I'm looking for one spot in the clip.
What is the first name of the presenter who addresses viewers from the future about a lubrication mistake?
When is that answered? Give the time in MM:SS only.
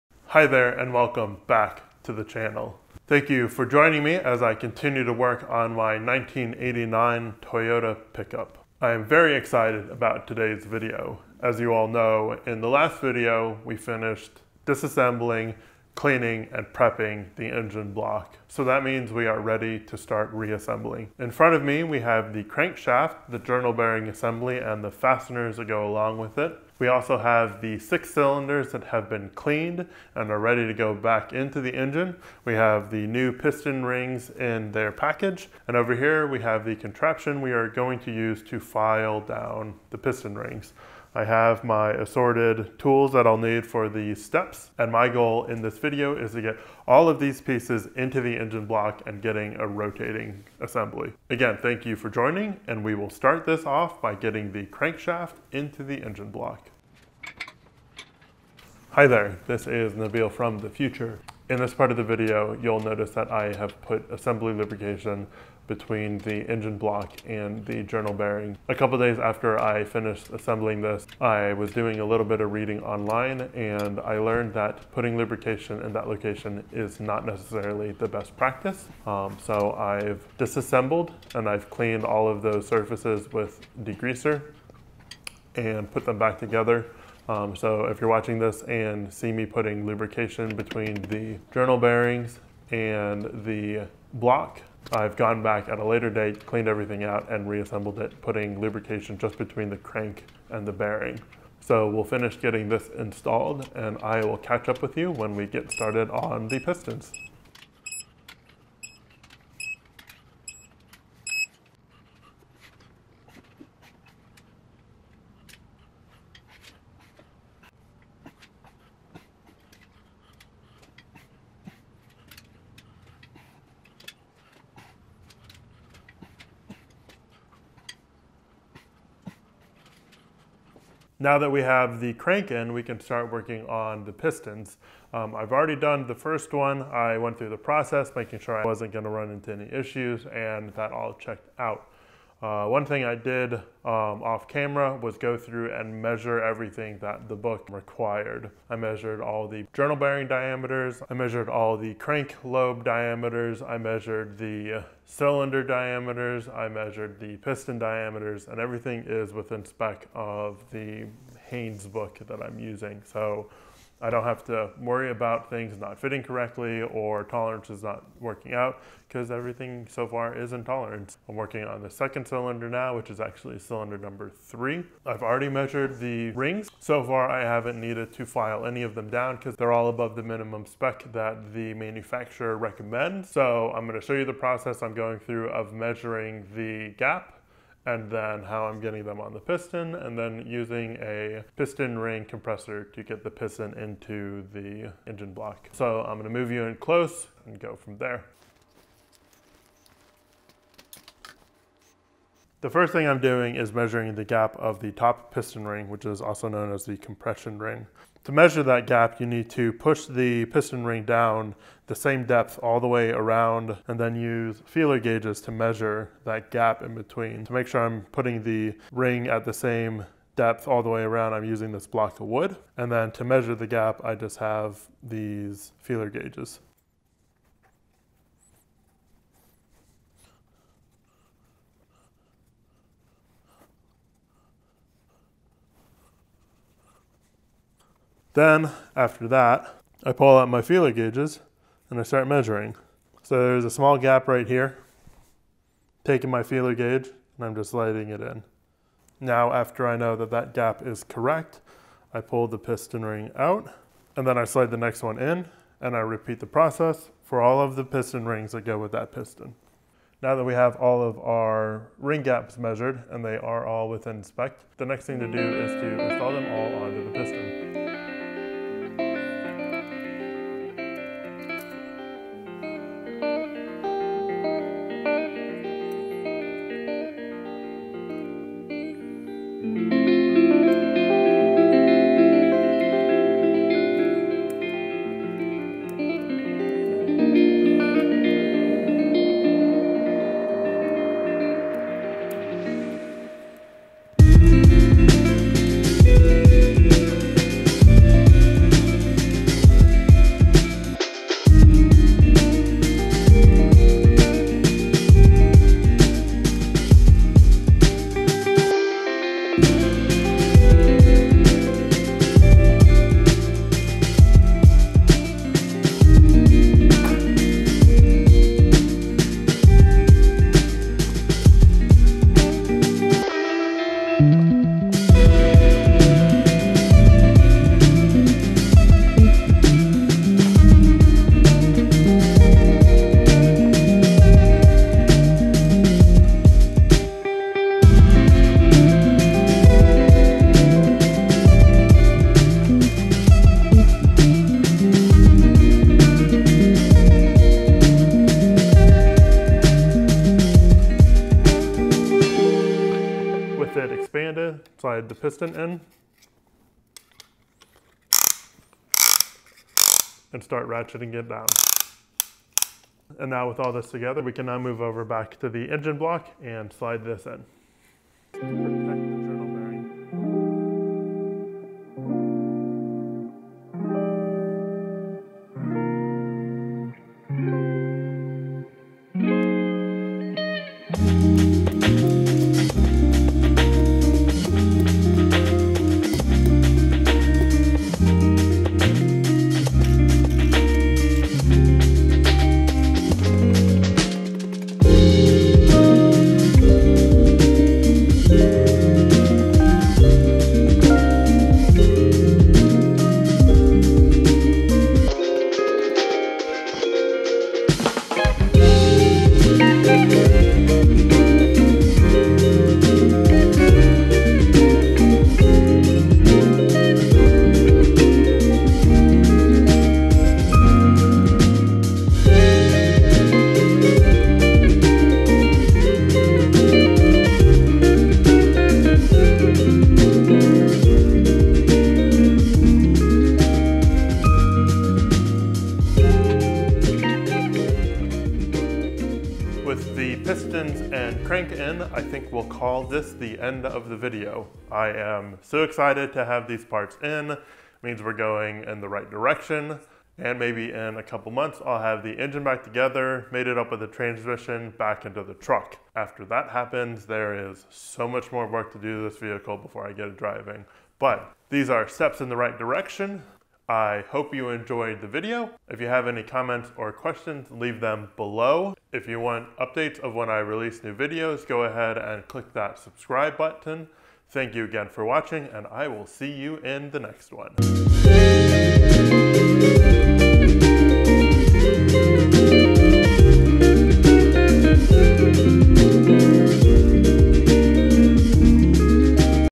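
00:59.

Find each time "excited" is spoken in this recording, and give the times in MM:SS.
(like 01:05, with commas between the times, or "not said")
00:09, 07:25.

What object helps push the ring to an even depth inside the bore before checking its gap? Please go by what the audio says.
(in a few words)
Block of wood.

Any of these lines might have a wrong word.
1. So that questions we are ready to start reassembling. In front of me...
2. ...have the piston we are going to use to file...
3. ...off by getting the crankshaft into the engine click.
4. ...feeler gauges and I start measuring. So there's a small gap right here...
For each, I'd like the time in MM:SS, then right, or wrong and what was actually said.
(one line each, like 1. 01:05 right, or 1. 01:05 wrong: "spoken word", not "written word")
1. 00:18 wrong: "means", not "questions"
2. 00:36 wrong: "contraption", not "piston"
3. 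00:53 wrong: "block", not "click"
4. 04:00 right.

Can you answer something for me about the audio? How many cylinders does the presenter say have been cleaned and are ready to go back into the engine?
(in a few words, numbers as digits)
6.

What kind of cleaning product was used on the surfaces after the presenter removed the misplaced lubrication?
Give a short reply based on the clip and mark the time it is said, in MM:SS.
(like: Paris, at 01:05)
Degreaser, at 01:23.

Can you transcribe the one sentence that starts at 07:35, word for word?
After that happens, there is so much more work to do to this vehicle before I get it driving.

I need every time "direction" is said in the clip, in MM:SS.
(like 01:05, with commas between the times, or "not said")
07:29, 07:42.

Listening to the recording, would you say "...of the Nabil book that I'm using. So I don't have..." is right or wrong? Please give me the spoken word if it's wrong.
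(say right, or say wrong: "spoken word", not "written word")
wrong: "Haynes", not "Nabil".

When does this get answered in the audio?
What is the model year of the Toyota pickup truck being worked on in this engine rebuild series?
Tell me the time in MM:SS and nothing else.
00:05.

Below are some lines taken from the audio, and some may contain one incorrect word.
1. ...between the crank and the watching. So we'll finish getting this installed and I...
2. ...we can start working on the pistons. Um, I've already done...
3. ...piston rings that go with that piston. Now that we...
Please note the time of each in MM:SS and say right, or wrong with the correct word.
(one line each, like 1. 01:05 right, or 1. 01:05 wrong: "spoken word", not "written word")
1. 01:39 wrong: "bearing", not "watching"
2. 02:12 right
3. 04:17 right.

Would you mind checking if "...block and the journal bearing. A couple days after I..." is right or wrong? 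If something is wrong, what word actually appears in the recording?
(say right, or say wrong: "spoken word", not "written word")
right.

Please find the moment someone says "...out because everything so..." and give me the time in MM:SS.
02:48.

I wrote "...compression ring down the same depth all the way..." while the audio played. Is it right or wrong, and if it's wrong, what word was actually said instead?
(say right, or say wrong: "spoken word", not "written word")
wrong: "piston", not "compression".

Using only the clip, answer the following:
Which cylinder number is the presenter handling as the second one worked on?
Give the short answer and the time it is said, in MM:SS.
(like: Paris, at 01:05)
3, at 02:53.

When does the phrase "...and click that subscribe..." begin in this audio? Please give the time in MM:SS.
07:51.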